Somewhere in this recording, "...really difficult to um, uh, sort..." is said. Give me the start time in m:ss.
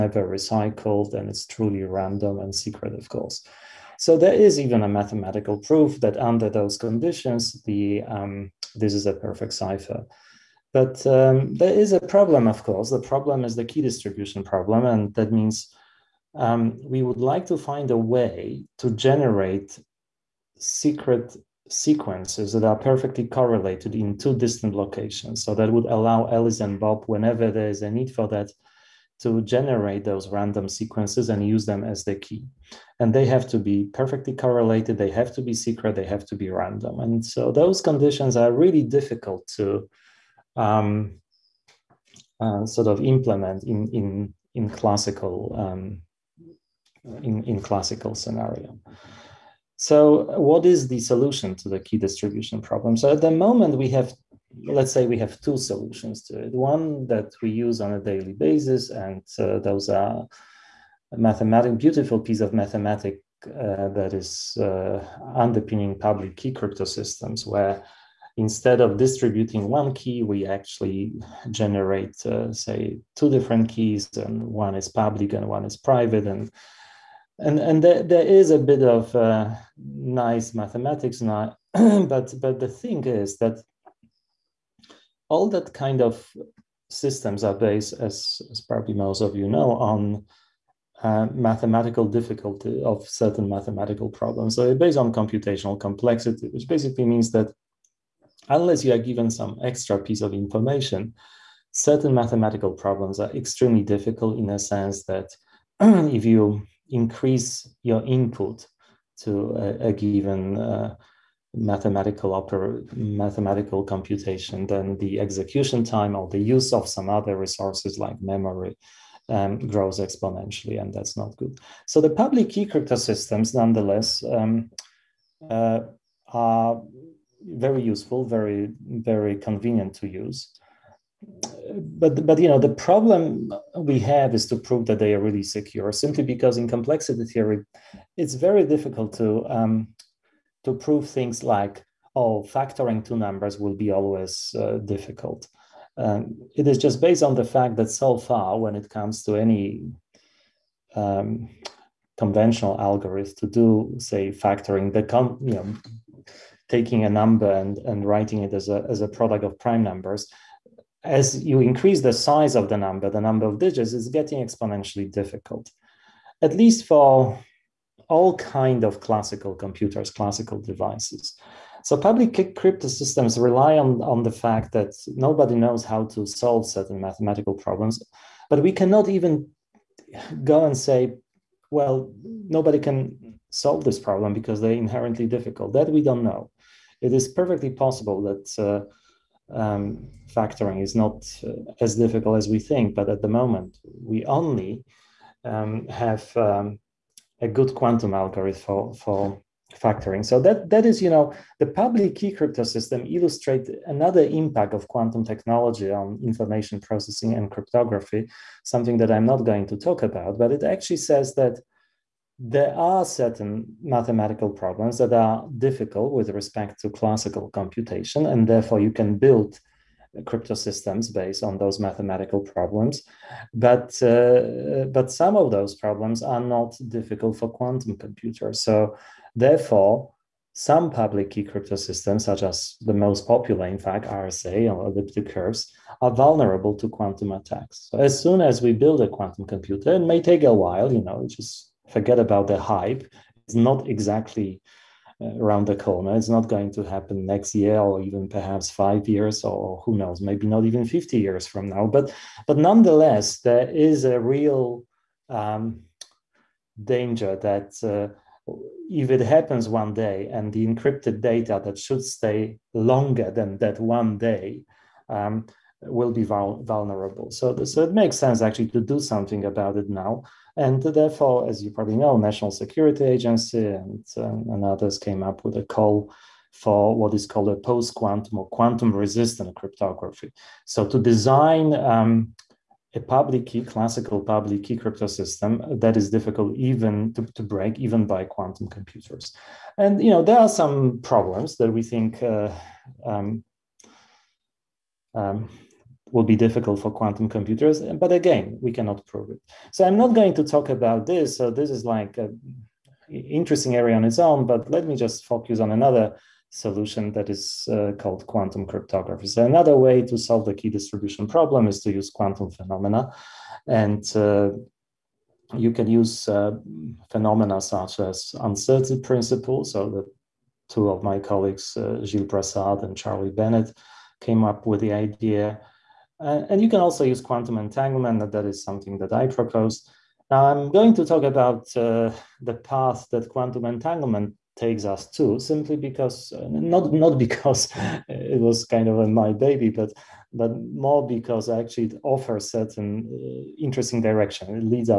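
0:38.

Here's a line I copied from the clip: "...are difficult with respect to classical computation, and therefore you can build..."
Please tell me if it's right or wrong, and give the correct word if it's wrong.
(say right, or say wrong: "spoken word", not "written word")
right.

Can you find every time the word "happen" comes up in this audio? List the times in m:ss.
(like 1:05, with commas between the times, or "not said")
4:06, 4:19.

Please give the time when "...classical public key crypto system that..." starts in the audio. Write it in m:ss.
4:43.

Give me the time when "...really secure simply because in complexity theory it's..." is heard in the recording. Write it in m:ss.
2:15.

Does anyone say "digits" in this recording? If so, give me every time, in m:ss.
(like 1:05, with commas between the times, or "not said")
2:43.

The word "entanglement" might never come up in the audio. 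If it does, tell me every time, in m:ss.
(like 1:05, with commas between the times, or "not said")
5:27, 5:33.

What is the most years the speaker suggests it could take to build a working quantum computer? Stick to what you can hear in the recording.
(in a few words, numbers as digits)
50.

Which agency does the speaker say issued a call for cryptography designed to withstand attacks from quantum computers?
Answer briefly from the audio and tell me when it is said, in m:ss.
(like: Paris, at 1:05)
National Security Agency, at 4:32.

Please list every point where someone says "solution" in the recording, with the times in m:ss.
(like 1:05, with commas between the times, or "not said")
0:50, 0:55, 5:06.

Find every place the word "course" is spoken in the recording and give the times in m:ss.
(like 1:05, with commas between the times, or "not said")
0:03, 0:12.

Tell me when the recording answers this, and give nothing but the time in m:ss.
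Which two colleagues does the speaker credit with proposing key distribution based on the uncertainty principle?
5:22.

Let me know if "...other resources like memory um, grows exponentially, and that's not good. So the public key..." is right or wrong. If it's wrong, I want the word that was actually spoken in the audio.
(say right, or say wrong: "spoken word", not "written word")
right.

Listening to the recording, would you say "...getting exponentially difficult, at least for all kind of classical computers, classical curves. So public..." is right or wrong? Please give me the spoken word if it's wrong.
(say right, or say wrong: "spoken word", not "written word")
wrong: "devices", not "curves".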